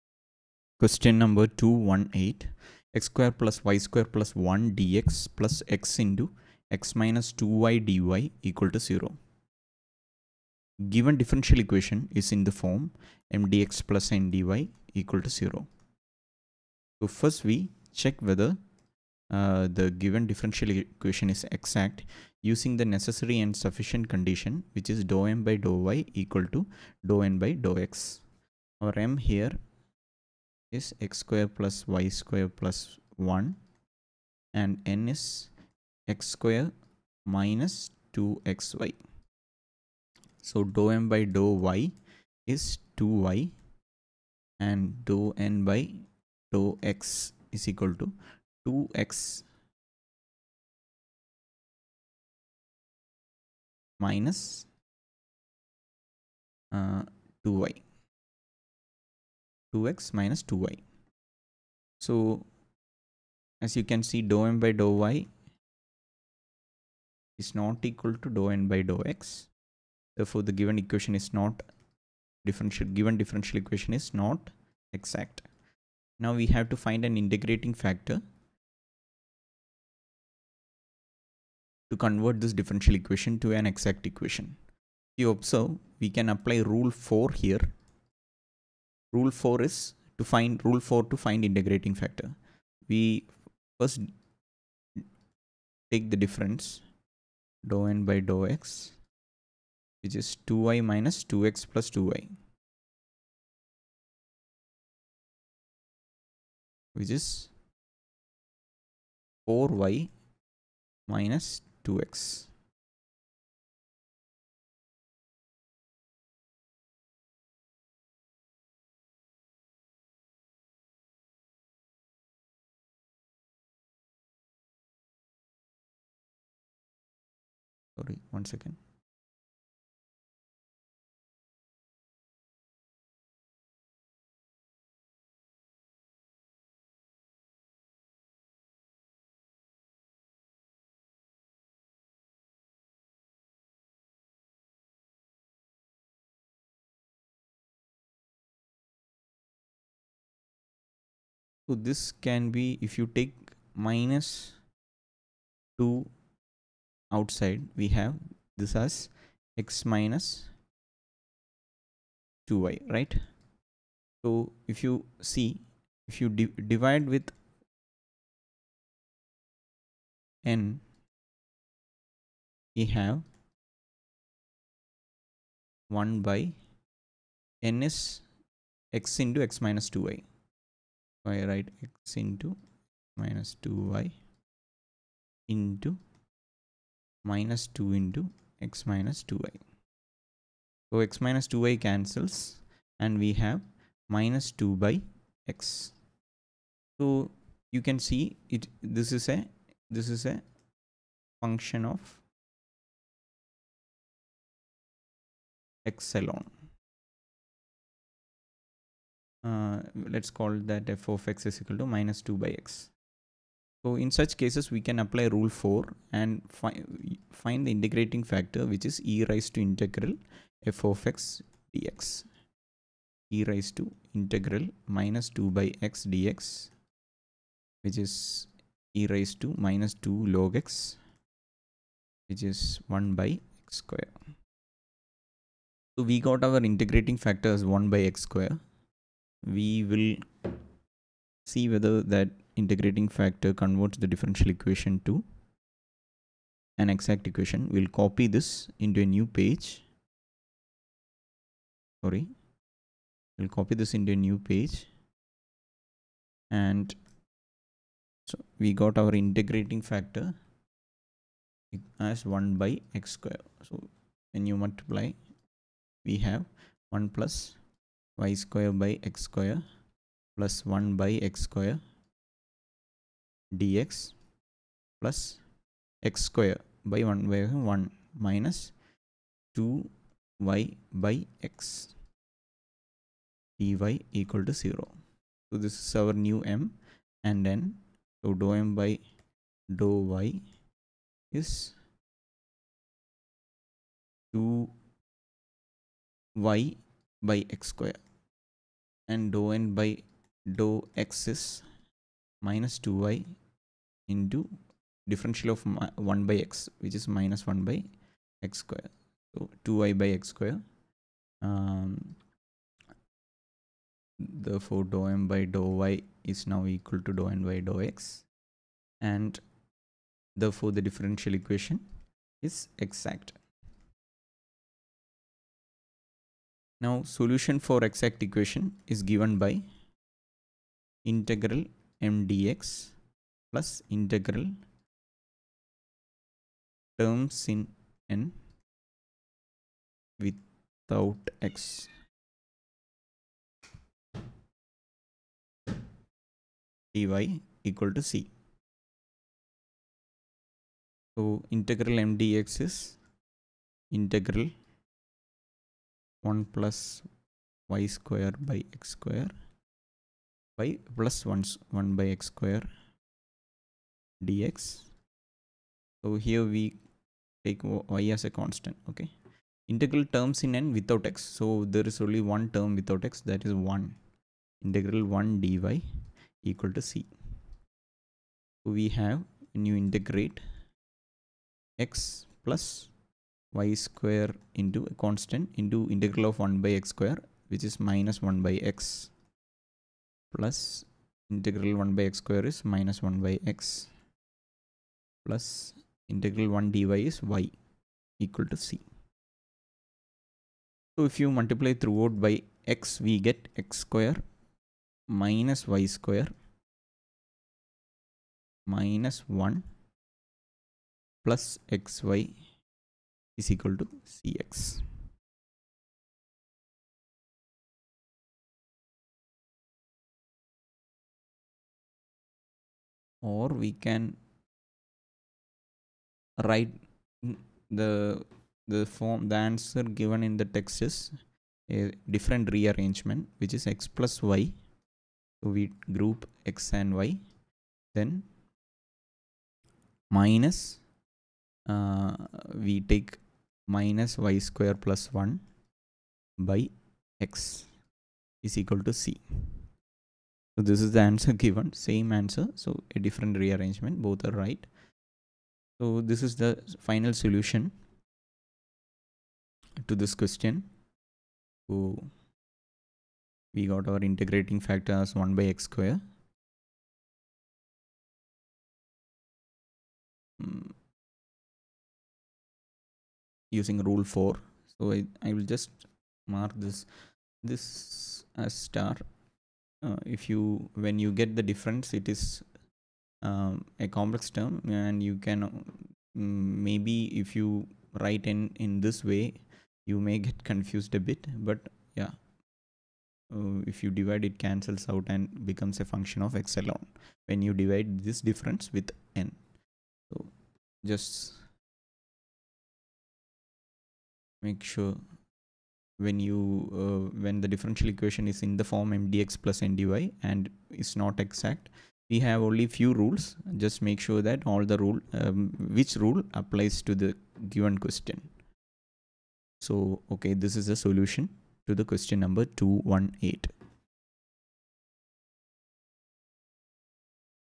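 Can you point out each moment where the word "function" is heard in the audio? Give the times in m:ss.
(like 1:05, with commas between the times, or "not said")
3:21, 8:15.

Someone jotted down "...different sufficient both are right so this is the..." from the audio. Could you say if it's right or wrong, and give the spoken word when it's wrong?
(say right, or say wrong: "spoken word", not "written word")
wrong: "rearrangement", not "sufficient".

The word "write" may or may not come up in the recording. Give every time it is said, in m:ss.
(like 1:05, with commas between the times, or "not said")
3:01, 7:06, 8:07.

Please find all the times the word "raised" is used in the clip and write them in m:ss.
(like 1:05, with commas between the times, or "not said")
3:39, 3:43, 3:49.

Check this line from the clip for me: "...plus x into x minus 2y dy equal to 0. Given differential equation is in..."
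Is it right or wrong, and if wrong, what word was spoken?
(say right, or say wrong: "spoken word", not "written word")
right.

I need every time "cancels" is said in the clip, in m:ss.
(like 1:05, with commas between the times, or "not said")
3:11, 8:14.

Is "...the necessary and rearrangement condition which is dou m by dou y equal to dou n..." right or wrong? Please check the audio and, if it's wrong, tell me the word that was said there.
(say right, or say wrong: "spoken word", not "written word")
wrong: "sufficient", not "rearrangement".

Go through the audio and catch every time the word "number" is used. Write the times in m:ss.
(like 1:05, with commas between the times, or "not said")
0:01, 8:42.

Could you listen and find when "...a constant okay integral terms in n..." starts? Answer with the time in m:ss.
6:08.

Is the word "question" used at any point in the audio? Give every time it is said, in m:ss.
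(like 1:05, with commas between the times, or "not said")
0:00, 7:40, 8:37, 8:41.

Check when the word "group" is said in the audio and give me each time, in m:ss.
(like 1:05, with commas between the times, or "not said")
7:15.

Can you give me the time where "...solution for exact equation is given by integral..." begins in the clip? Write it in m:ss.
5:27.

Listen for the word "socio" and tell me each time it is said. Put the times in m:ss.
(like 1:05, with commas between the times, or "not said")
not said.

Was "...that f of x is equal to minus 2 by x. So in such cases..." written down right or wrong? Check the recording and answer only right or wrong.
right.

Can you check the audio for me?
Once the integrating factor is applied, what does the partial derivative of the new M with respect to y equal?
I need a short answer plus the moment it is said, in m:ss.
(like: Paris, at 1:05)
2y/x^2, at 4:54.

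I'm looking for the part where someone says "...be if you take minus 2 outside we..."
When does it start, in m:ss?
2:32.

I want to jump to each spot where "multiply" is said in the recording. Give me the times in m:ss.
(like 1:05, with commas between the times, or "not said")
4:24, 6:41.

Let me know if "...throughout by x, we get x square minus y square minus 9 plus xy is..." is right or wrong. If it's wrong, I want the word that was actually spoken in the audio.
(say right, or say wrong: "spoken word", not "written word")
wrong: "1", not "9".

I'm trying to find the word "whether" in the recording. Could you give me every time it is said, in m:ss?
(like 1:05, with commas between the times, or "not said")
0:18, 4:01.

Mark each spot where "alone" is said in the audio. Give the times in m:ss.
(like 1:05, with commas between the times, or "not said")
3:26, 8:16.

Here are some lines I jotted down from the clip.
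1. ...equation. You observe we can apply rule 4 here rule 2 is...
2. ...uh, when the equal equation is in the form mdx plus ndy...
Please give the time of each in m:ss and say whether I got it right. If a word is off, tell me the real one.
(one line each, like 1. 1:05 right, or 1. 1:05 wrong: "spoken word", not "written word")
1. 1:24 wrong: "4", not "2"
2. 8:26 wrong: "differential", not "equal".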